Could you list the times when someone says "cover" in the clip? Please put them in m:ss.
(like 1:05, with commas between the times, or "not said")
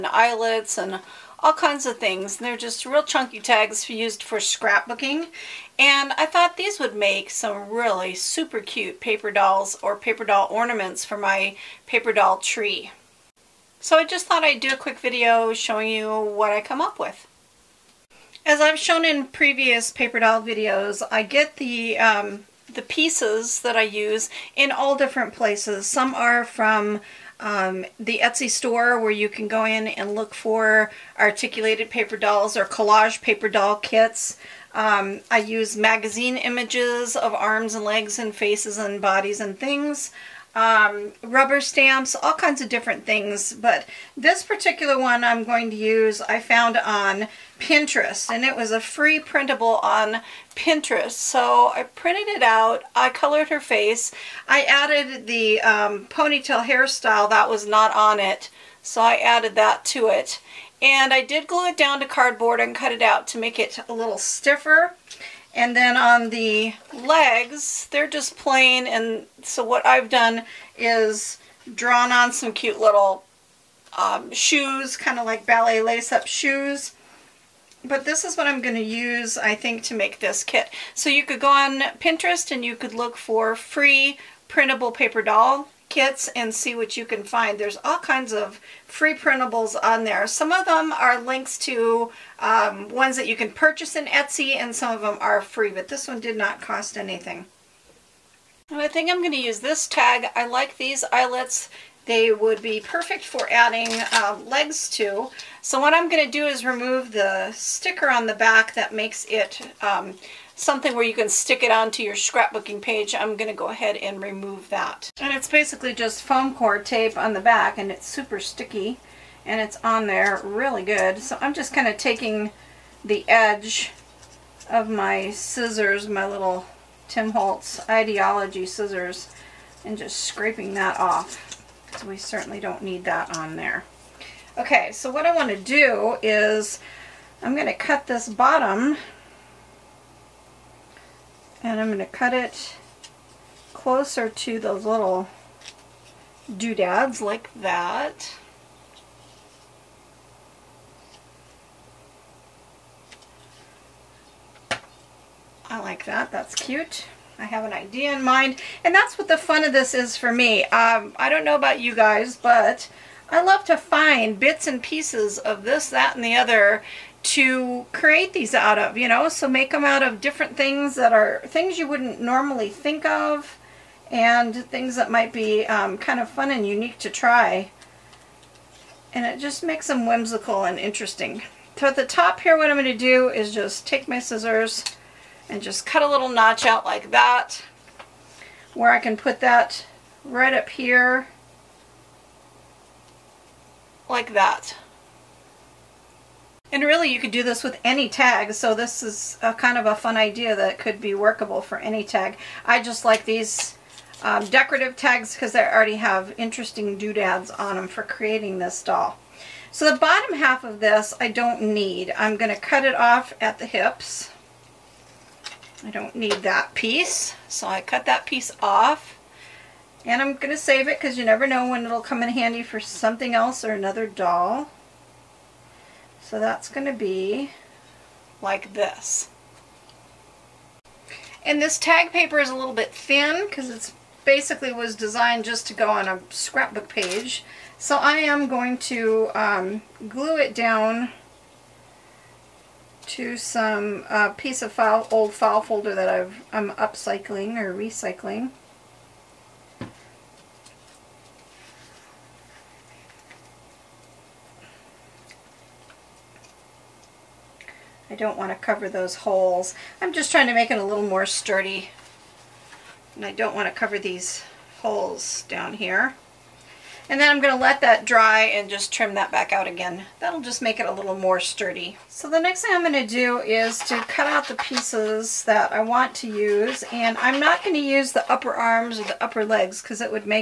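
4:18, 4:23.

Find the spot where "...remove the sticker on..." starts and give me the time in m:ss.
1:46.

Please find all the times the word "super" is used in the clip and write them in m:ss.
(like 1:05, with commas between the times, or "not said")
0:08, 1:58.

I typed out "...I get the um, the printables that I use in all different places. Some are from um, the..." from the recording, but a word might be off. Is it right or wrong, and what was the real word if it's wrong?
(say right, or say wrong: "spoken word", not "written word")
wrong: "pieces", not "printables".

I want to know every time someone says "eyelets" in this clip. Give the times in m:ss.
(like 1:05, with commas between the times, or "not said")
0:00, 1:41.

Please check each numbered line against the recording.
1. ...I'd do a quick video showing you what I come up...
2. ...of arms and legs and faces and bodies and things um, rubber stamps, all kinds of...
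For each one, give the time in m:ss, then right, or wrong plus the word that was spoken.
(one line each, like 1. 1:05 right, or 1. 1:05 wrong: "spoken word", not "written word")
1. 0:14 right
2. 0:37 right.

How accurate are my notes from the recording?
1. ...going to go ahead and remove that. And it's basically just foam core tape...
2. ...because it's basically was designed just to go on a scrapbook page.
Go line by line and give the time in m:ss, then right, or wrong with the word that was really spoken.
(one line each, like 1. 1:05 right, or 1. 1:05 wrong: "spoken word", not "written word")
1. 1:53 right
2. 3:53 right.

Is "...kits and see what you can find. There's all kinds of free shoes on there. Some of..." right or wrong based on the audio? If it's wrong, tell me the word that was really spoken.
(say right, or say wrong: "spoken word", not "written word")
wrong: "printables", not "shoes".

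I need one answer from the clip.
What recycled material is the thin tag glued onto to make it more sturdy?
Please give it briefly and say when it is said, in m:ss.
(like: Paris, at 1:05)
old file folder, at 4:05.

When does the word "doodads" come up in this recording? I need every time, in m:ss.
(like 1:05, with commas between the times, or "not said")
2:26, 3:26.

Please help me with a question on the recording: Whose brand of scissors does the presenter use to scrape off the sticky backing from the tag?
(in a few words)
Tim Holtz.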